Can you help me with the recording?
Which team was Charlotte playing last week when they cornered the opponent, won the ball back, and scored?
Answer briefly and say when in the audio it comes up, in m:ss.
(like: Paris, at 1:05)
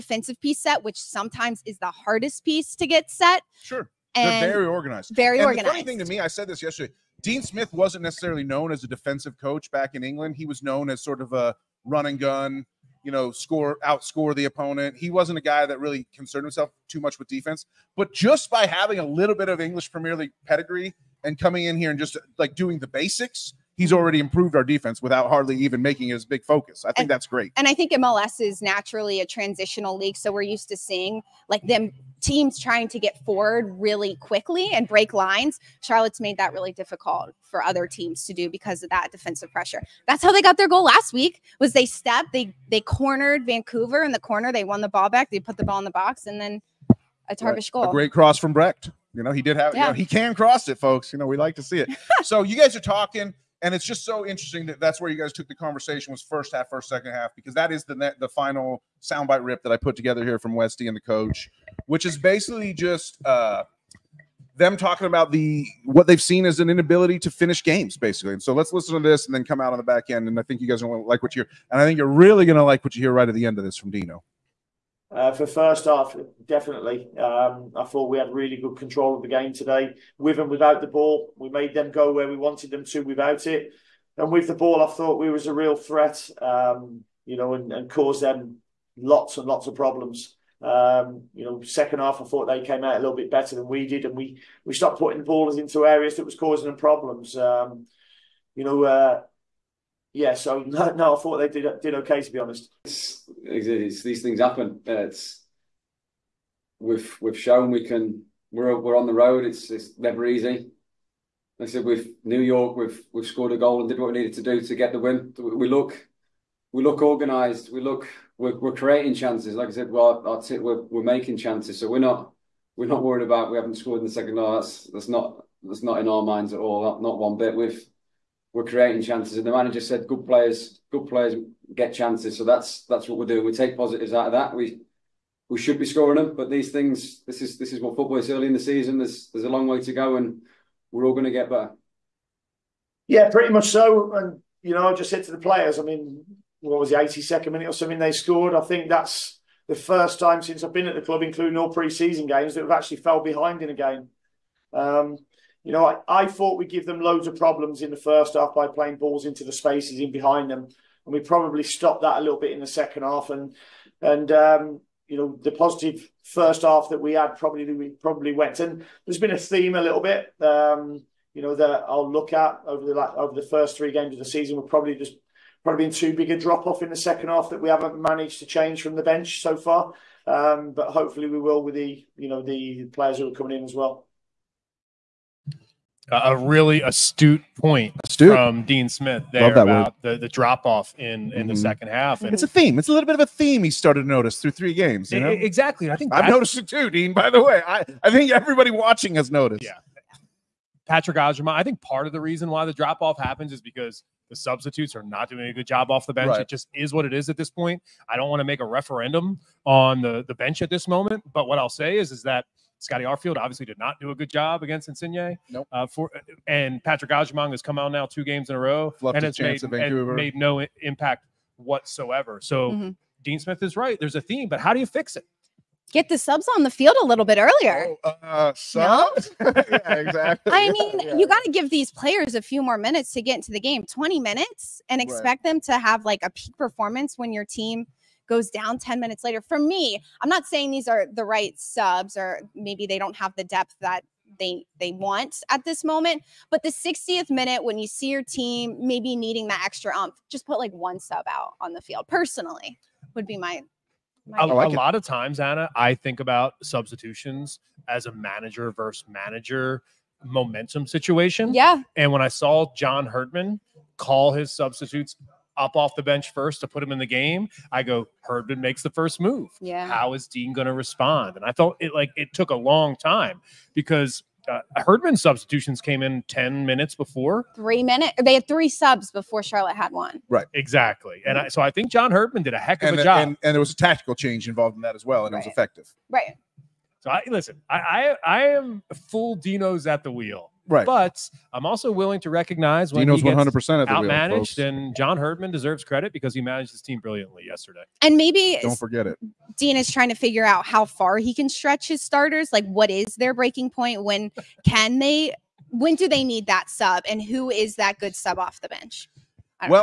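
Vancouver, at 0:43.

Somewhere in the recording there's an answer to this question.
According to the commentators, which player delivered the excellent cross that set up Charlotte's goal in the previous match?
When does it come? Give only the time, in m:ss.
0:48.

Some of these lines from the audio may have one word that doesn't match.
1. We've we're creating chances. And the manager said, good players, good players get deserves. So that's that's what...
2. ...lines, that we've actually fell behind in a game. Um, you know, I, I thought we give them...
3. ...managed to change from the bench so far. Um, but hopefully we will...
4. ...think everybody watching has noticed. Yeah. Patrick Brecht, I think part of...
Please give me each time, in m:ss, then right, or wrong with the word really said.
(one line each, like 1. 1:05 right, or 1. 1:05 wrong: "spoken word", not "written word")
1. 2:07 wrong: "chances", not "deserves"
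2. 2:32 wrong: "games", not "lines"
3. 2:58 right
4. 3:18 wrong: "Agyemang", not "Brecht".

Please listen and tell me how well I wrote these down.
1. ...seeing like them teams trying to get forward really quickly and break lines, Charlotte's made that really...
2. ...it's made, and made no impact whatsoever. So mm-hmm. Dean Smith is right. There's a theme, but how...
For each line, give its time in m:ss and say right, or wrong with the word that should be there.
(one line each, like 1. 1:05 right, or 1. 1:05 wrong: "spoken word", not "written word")
1. 0:30 right
2. 3:39 right.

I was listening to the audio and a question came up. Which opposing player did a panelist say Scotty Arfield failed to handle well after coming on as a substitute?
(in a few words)
Insigne.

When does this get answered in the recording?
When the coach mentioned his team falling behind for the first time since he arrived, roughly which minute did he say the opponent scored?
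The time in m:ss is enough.
2:26.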